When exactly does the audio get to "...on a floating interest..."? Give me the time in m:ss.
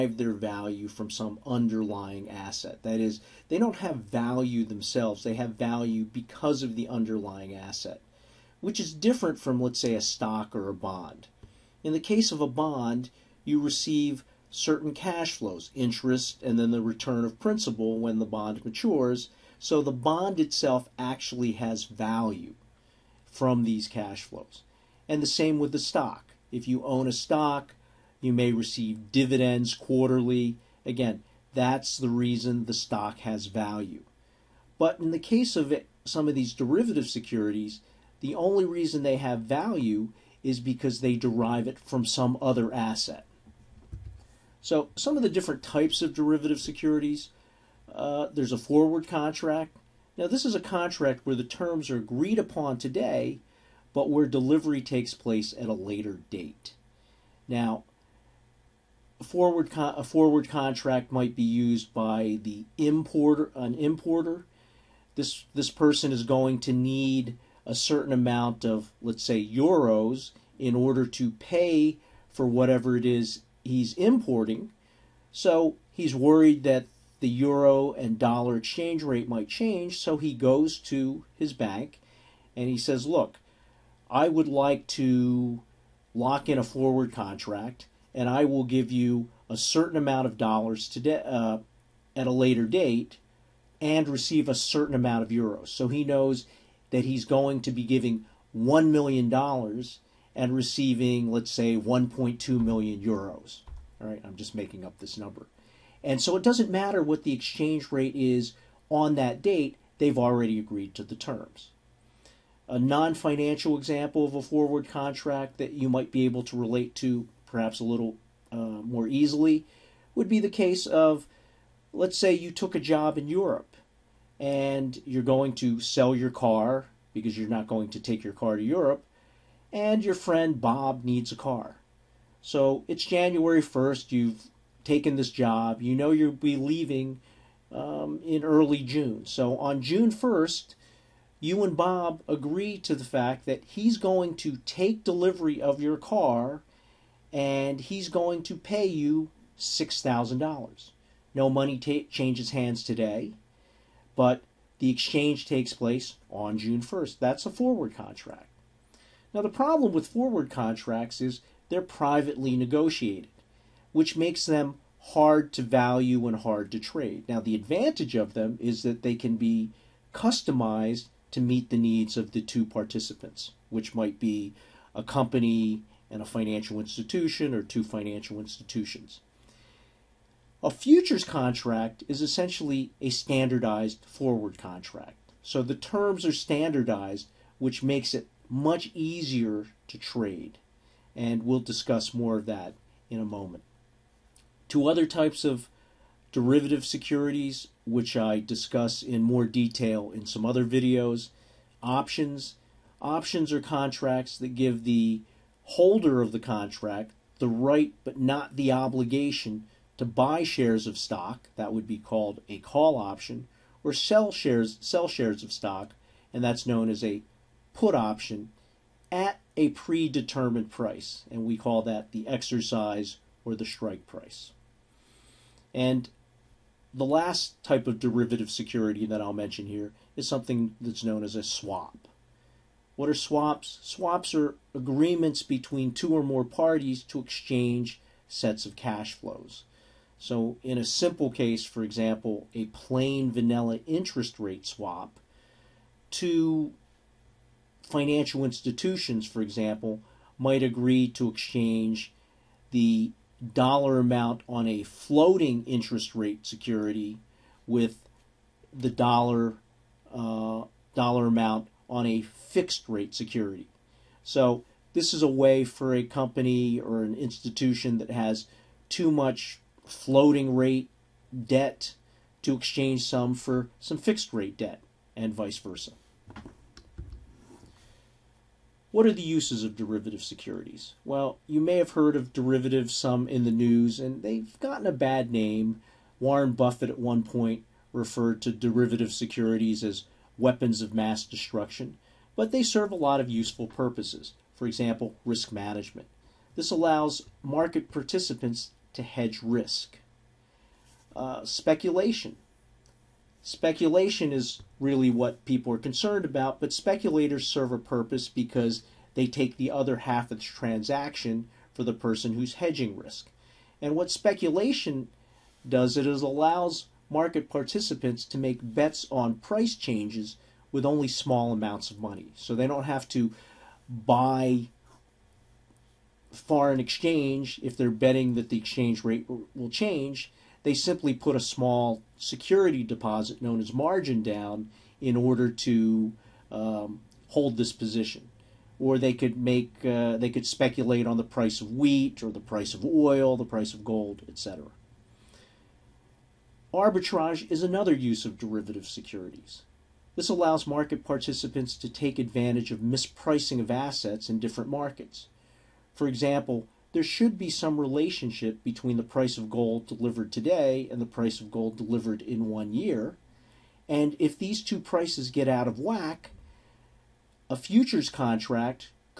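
4:14.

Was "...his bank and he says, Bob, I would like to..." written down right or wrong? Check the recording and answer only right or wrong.
wrong.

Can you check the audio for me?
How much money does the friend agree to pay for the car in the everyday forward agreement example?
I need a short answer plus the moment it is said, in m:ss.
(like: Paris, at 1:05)
$6,000, at 2:29.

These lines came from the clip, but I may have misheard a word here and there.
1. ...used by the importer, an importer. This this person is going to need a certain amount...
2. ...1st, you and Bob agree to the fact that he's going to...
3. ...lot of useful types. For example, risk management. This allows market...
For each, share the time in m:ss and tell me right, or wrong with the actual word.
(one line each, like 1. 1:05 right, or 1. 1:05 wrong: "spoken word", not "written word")
1. 1:01 right
2. 2:20 right
3. 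4:52 wrong: "purposes", not "types".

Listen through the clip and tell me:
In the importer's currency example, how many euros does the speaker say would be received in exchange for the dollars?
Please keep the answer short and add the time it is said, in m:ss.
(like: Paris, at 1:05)
1.2 million euros, at 1:41.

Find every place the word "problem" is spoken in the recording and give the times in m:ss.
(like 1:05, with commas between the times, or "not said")
2:39.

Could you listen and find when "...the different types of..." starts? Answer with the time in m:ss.
0:45.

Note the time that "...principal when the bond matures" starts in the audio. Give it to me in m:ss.
0:17.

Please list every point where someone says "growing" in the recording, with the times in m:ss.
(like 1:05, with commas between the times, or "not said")
not said.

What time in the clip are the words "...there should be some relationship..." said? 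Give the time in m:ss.
5:56.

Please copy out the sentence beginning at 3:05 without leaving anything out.
So the terms are standardized, which makes it much easier to trade.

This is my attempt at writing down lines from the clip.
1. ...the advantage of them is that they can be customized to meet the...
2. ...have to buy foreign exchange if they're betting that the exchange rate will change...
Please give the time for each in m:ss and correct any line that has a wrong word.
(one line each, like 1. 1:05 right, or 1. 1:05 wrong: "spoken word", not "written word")
1. 2:47 right
2. 5:22 right.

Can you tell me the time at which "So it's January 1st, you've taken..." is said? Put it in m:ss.
2:12.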